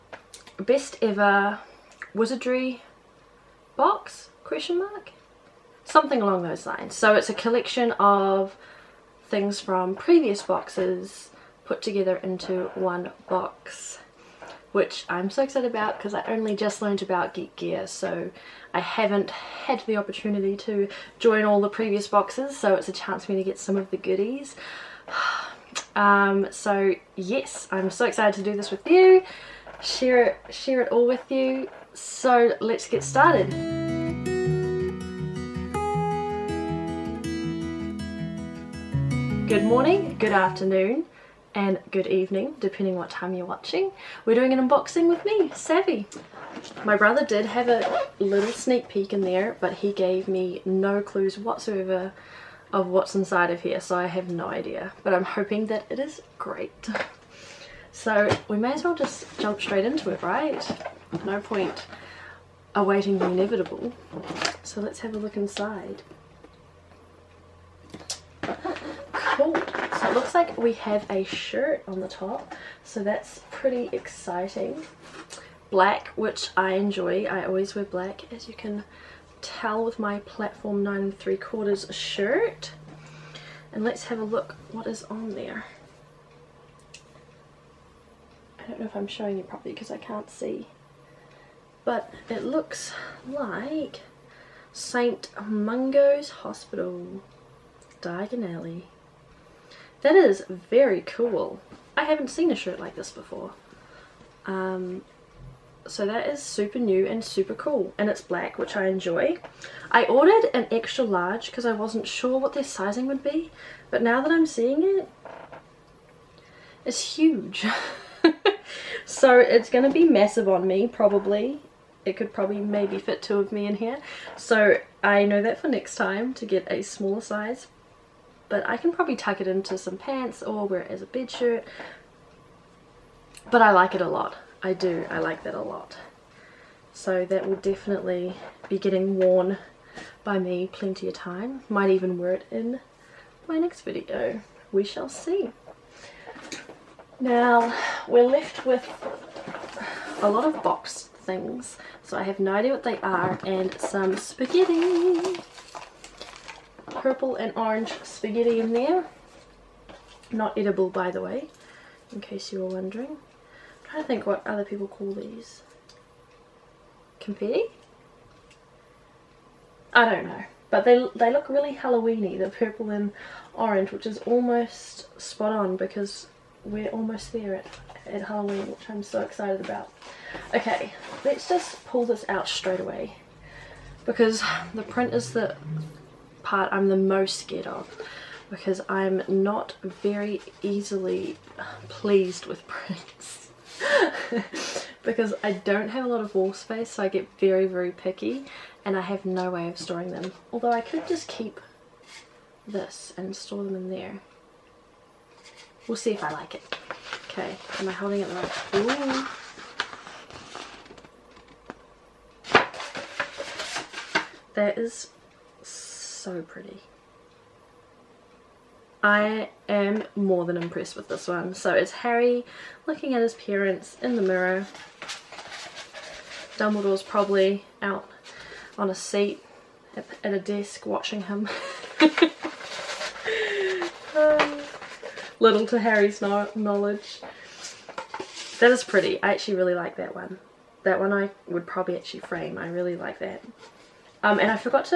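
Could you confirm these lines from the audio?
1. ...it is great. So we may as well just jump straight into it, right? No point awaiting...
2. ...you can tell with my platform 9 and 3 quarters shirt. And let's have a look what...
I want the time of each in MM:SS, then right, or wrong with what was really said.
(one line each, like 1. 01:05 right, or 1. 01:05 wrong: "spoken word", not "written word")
1. 00:55 right
2. 01:18 right.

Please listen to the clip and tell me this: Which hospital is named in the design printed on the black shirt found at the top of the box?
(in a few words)
St. Mungo's Hospital.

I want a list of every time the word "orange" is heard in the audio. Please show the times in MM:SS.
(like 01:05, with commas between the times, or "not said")
02:37, 02:53.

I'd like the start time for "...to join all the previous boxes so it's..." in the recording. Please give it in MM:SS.
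00:20.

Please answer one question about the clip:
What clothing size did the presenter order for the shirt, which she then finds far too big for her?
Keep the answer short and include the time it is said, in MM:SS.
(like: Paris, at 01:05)
Extra large, at 01:50.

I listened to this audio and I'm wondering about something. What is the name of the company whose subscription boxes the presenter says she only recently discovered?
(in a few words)
Geek Gear.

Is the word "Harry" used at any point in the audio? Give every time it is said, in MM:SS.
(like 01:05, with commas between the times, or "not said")
03:41, 03:55.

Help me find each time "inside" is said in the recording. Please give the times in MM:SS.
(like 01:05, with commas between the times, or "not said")
00:53, 01:05.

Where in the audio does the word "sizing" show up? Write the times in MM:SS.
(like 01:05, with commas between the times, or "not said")
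01:52.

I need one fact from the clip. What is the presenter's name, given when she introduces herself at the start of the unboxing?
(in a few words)
Savvy.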